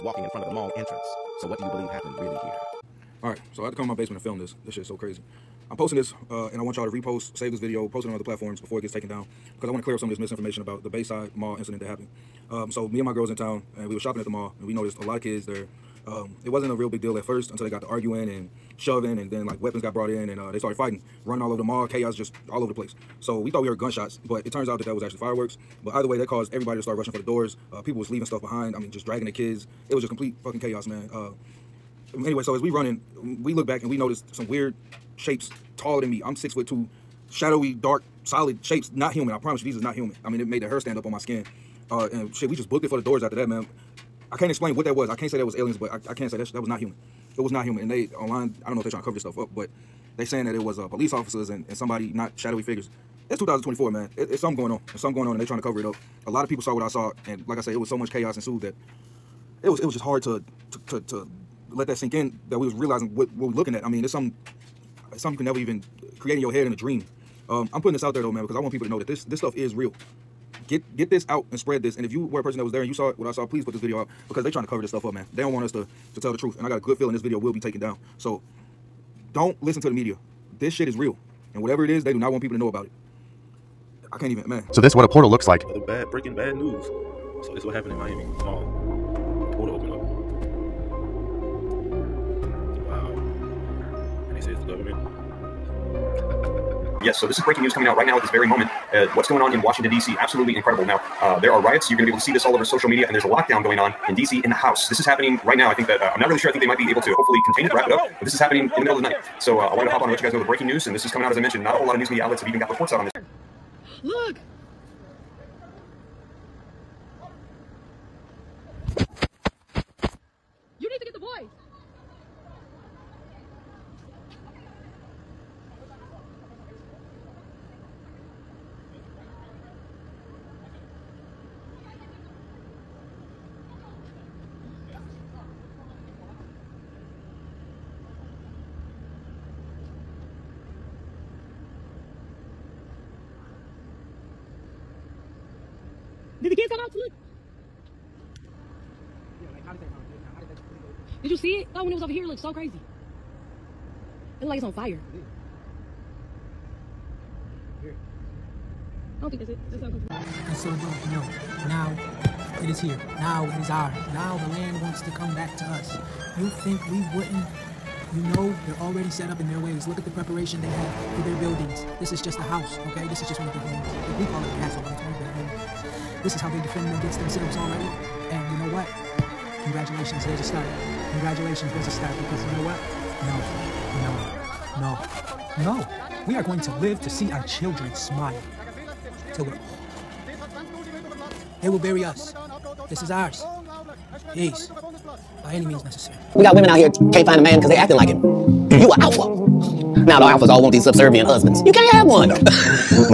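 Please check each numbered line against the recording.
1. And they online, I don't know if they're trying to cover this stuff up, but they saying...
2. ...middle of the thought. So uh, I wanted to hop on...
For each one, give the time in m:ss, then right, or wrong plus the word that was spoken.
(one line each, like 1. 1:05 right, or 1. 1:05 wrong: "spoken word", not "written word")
1. 0:47 right
2. 1:48 wrong: "night", not "thought".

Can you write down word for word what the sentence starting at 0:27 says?
Uh, people was leaving stuff behind.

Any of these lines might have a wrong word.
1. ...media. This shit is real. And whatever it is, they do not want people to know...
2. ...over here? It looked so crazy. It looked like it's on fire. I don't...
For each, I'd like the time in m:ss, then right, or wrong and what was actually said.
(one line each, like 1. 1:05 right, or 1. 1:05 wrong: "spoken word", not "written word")
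1. 1:19 right
2. 2:32 right.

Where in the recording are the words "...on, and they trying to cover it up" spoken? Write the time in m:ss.
0:55.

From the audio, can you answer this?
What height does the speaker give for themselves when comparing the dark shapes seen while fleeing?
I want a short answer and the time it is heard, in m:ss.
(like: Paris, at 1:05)
6 foot 2, at 0:36.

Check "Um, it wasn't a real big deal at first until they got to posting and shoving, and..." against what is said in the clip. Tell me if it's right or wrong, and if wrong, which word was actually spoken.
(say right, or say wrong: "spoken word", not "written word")
wrong: "arguing", not "posting".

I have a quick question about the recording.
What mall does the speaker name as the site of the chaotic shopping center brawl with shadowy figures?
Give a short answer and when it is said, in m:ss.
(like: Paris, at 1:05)
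Bayside Mall, at 0:10.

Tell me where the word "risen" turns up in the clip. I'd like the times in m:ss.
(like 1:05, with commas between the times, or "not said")
not said.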